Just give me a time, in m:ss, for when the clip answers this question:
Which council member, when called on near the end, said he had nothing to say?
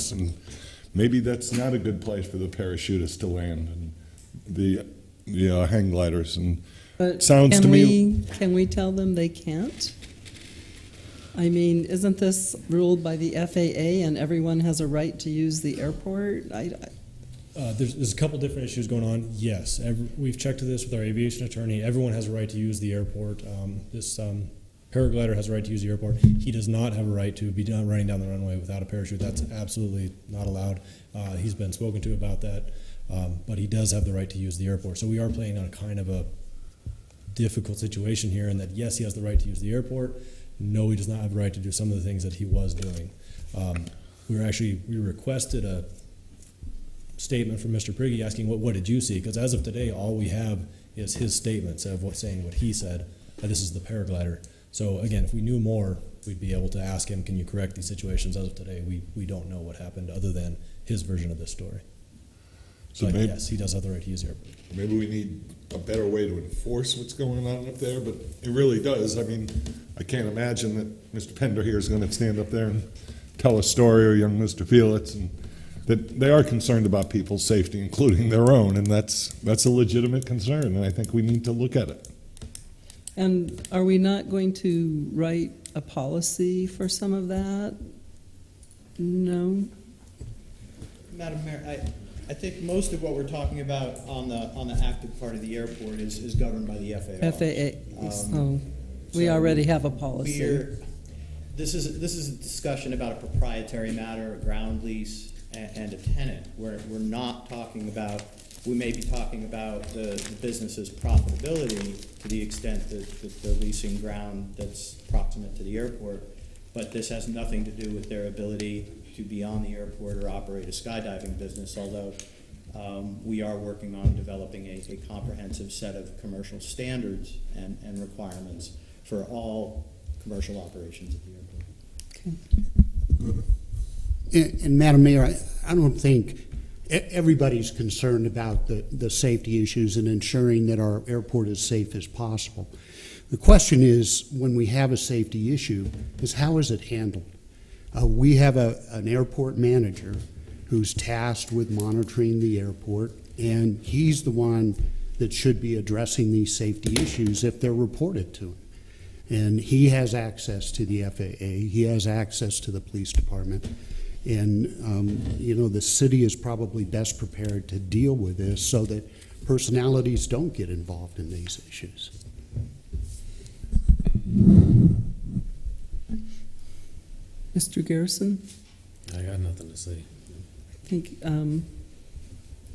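2:57.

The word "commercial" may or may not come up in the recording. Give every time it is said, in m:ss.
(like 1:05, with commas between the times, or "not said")
2:06, 2:10.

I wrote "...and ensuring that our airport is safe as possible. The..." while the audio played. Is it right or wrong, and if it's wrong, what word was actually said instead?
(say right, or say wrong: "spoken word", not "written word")
right.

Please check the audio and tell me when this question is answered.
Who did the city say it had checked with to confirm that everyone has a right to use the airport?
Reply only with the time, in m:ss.
0:21.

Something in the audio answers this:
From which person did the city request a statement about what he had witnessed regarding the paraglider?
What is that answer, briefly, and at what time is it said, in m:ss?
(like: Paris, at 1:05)
Mr. Prigge, at 0:47.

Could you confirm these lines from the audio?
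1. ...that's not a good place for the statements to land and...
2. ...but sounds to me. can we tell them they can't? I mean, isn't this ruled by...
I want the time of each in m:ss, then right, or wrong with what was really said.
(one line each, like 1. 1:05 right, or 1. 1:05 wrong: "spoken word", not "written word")
1. 0:01 wrong: "parachutists", not "statements"
2. 0:06 right.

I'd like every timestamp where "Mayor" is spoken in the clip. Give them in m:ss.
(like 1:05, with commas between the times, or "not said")
1:31, 2:15.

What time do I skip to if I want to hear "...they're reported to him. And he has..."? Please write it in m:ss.
2:37.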